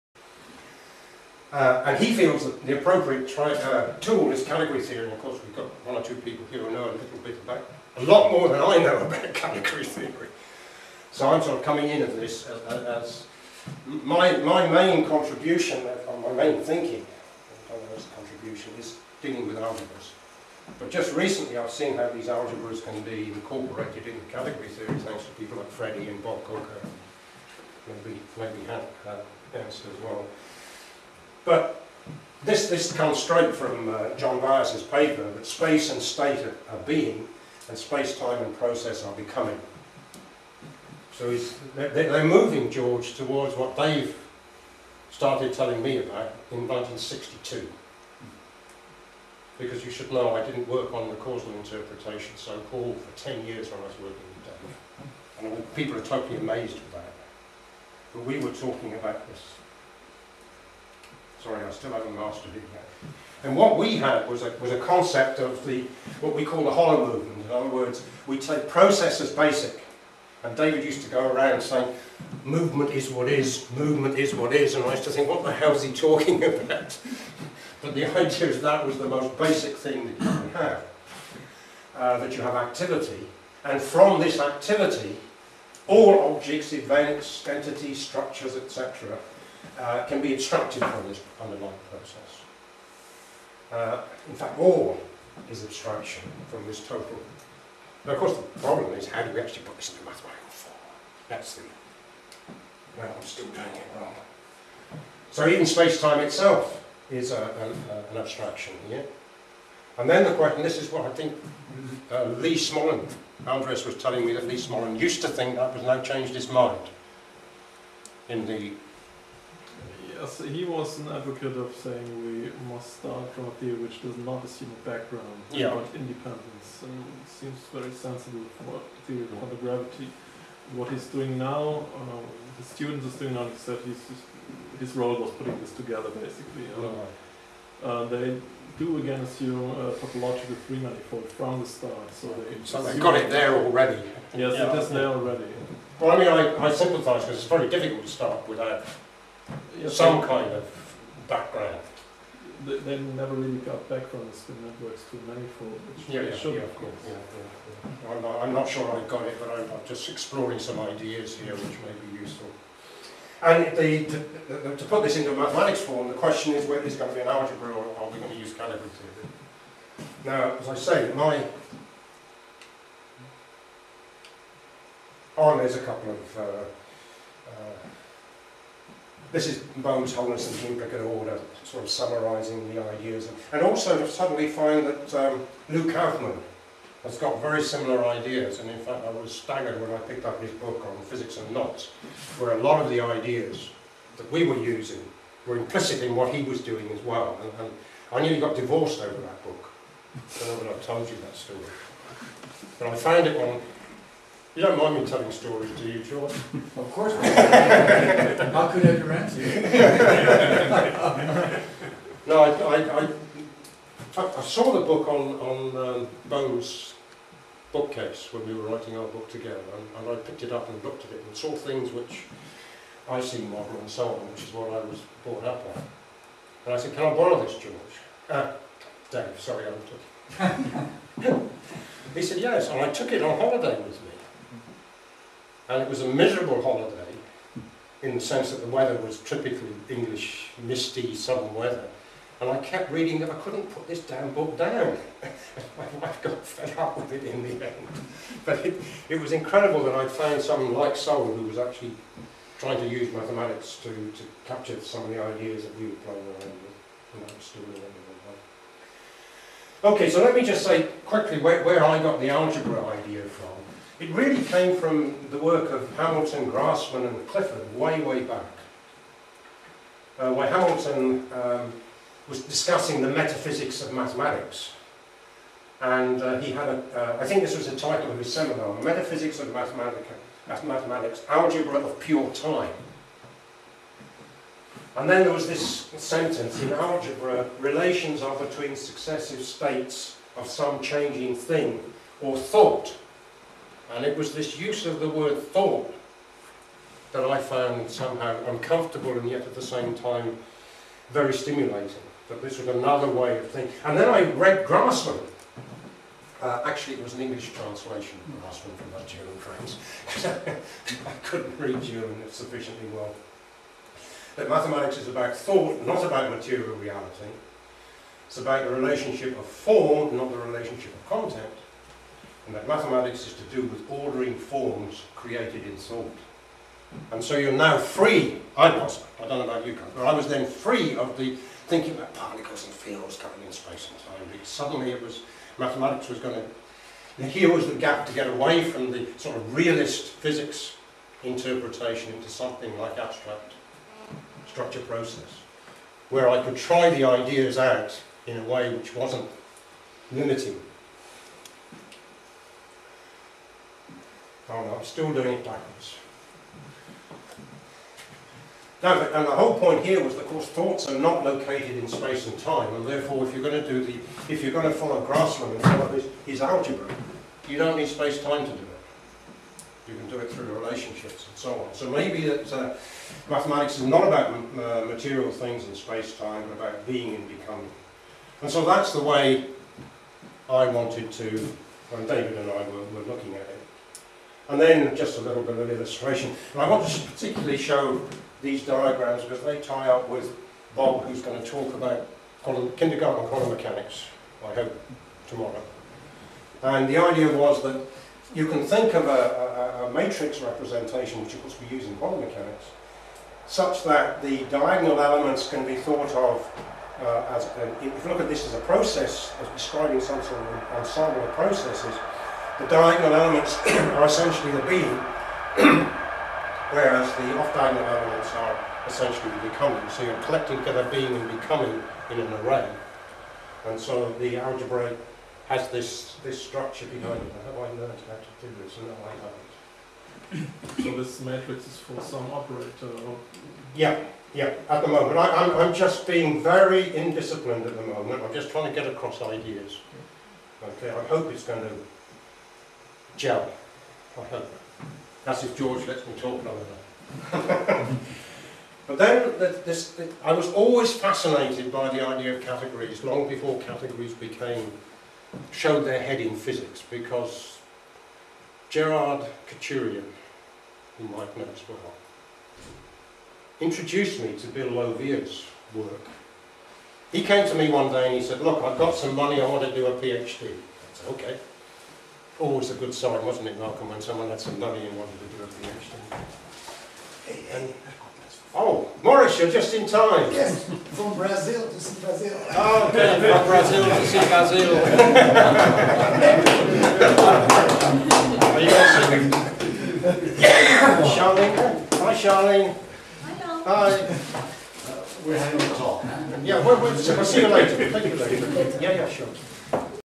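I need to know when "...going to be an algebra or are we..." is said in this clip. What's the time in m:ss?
2:46.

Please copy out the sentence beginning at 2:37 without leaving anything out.
Yeah, yeah, I'm, not, I'm, not, sure I got it, but I'm, I'm, just exploring some ideas here which may be useful.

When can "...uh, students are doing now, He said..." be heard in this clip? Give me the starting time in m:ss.
2:11.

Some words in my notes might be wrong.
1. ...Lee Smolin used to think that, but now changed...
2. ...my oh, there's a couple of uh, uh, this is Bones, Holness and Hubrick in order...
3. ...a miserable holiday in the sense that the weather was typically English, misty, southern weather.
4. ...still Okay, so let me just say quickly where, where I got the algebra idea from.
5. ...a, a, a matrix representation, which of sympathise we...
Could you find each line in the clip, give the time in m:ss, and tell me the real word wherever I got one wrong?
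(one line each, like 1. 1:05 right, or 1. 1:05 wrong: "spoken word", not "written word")
1. 1:54 right
2. 2:51 right
3. 3:56 right
4. 4:17 right
5. 6:39 wrong: "course", not "sympathise".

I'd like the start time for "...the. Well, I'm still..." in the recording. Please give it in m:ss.
1:41.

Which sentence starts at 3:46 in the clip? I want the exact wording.
And I said, can I borrow this, George?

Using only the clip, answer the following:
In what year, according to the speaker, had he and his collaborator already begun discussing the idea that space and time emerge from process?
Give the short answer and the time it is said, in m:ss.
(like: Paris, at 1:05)
1962, at 0:46.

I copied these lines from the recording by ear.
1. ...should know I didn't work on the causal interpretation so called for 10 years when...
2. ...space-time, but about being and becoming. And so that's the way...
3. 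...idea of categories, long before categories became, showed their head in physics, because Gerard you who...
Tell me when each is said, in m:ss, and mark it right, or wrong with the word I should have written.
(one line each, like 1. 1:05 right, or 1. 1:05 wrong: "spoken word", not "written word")
1. 0:49 right
2. 6:15 right
3. 7:32 right.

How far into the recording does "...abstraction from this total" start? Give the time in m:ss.
1:35.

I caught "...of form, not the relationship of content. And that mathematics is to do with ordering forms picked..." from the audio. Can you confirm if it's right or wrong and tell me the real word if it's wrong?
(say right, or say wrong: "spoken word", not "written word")
wrong: "created", not "picked".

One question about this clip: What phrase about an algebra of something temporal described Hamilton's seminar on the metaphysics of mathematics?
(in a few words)
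Algebra of Pure Time.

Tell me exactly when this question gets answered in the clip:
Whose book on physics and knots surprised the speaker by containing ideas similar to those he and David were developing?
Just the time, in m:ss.
3:05.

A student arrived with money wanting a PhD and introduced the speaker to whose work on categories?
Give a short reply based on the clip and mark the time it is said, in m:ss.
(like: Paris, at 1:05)
Bill Lawvere, at 7:44.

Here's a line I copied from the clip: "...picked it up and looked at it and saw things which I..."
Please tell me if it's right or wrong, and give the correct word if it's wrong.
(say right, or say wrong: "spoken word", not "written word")
right.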